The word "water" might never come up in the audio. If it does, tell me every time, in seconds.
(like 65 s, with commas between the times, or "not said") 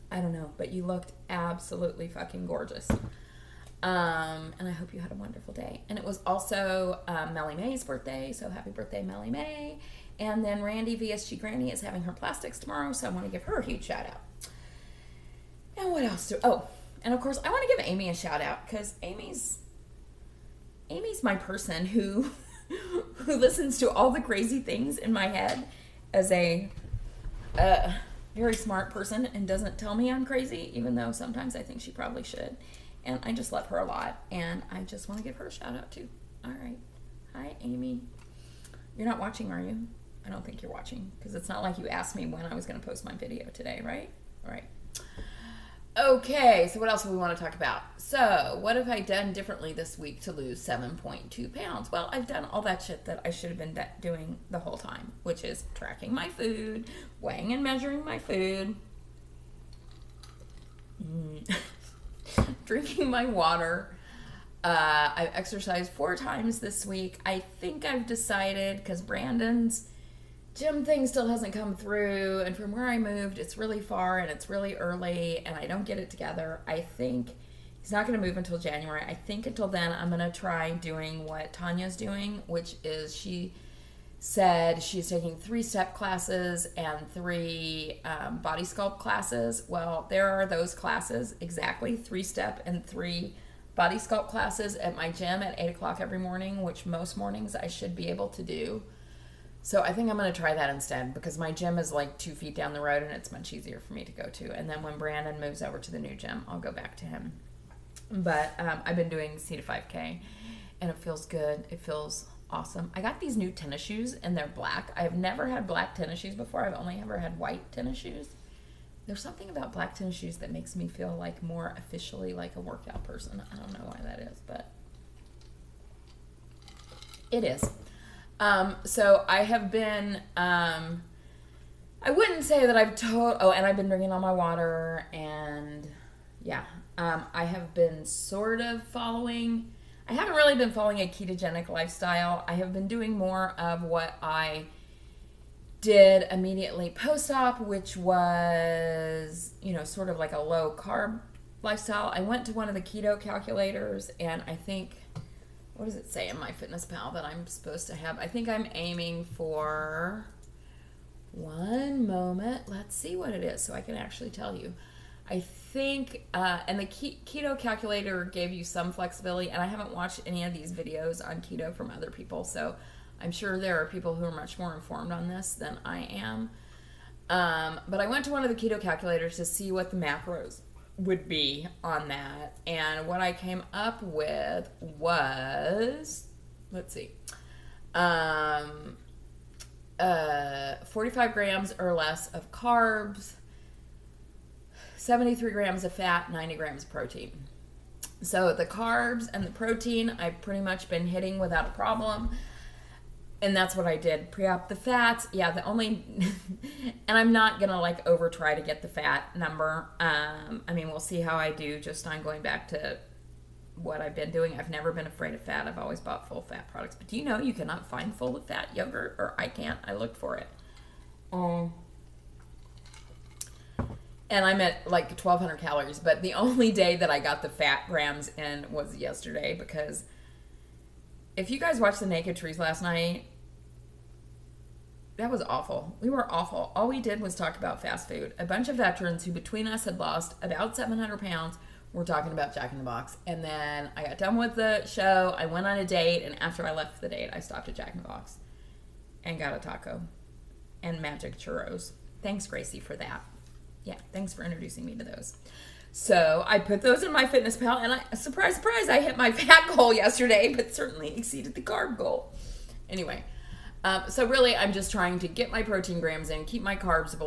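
63 s, 134 s.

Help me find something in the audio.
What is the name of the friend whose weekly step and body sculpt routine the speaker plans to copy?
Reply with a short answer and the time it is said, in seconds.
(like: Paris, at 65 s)
Tanya, at 81 s.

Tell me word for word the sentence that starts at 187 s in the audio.
Um, uh, 45 grams or less of carbs, 73 grams of fat, 90 grams of protein.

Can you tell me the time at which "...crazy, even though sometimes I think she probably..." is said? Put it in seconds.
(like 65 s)
30 s.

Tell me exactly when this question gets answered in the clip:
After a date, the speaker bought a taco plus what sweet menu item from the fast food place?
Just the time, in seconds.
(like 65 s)
251 s.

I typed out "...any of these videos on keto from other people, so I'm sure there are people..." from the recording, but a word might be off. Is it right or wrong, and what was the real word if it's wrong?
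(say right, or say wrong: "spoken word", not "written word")
right.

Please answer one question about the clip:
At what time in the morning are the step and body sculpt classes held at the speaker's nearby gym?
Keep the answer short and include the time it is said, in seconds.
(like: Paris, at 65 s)
8 o'clock, at 95 s.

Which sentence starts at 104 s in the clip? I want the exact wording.
And then when Brandon moves over to the new gym, I'll go back to him.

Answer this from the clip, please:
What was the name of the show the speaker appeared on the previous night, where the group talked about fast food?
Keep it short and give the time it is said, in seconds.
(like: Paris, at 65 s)
the Naked Truth, at 232 s.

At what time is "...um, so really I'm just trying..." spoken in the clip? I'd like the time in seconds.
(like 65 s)
263 s.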